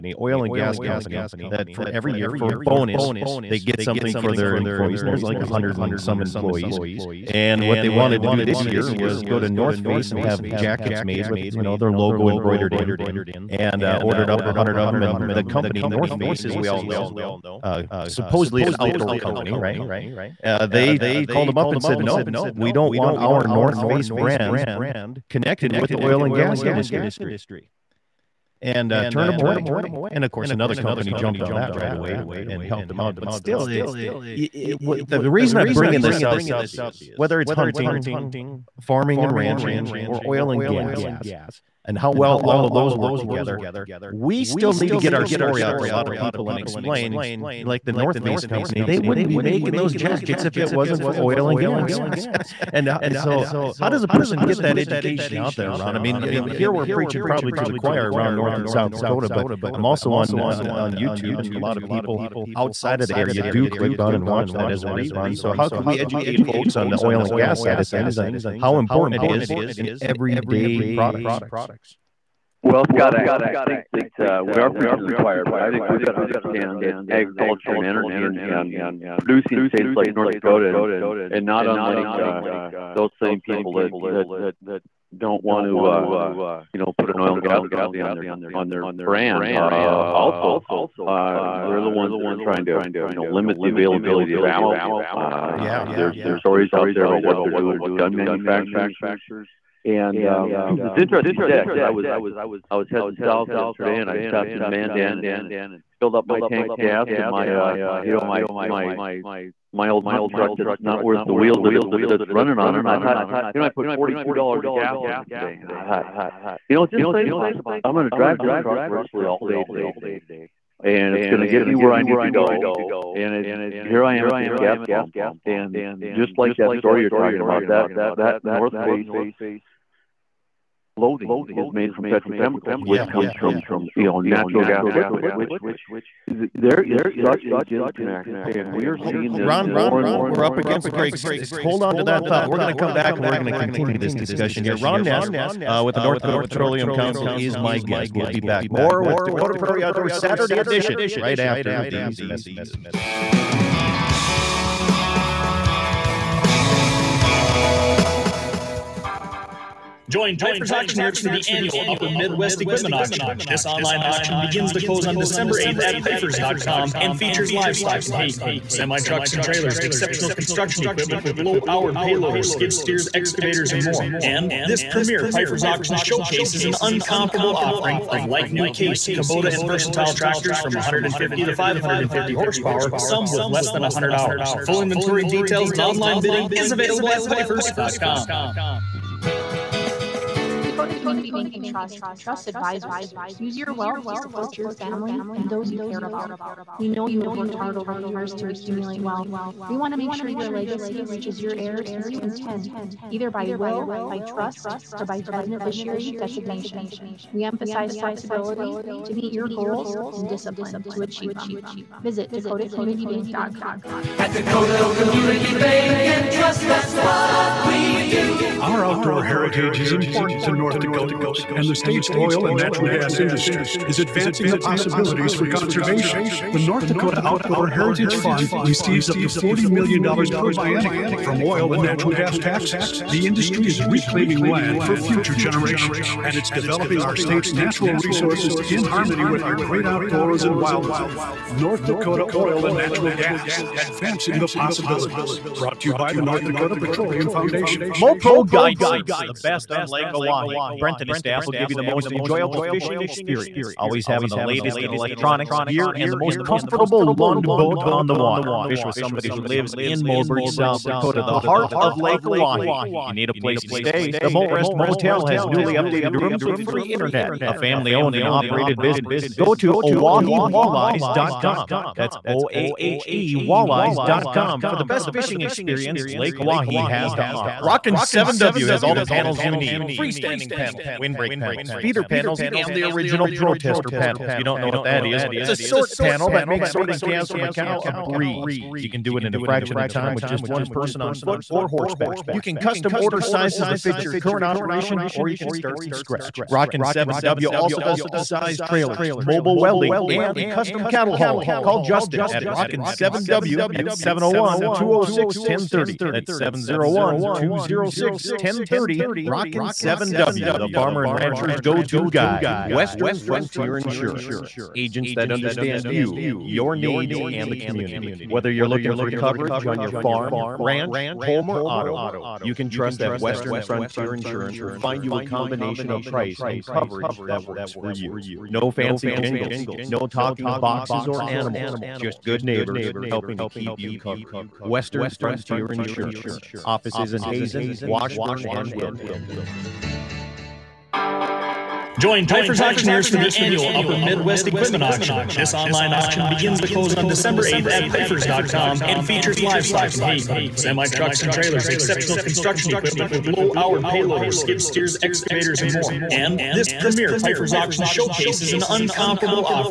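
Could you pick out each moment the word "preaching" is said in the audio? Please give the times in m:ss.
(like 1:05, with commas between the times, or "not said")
0:56, 1:14.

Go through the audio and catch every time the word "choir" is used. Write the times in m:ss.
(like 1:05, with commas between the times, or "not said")
0:57, 1:15.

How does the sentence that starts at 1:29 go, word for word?
Uh, also, uh, they're the ones that are trying to, you know, limit the availability of ammo.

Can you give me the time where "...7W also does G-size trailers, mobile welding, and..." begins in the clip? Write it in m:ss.
4:56.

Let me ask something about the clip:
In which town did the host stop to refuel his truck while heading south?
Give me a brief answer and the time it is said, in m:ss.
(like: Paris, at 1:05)
Mandan, at 1:44.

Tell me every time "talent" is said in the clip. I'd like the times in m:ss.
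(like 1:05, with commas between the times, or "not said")
not said.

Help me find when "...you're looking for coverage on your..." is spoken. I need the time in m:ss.
5:18.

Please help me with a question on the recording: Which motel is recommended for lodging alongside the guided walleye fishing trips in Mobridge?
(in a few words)
Molrest Motel.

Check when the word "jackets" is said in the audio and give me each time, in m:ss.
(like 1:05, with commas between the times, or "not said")
0:10, 0:49.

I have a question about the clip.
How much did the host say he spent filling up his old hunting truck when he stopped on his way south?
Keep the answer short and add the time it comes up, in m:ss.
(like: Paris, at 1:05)
$42, at 1:53.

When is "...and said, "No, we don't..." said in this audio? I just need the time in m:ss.
0:21.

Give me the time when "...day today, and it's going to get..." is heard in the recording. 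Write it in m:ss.
1:59.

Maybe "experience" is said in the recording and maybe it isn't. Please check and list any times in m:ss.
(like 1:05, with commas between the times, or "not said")
4:13, 4:35.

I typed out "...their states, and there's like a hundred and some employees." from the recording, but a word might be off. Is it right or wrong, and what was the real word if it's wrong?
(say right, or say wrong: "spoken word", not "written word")
wrong: "employees", not "states".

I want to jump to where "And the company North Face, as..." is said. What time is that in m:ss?
0:15.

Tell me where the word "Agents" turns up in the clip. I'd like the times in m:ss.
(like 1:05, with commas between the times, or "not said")
5:14.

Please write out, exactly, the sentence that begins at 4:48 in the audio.
You can do it in a fraction of time with just one person on foot or horseback.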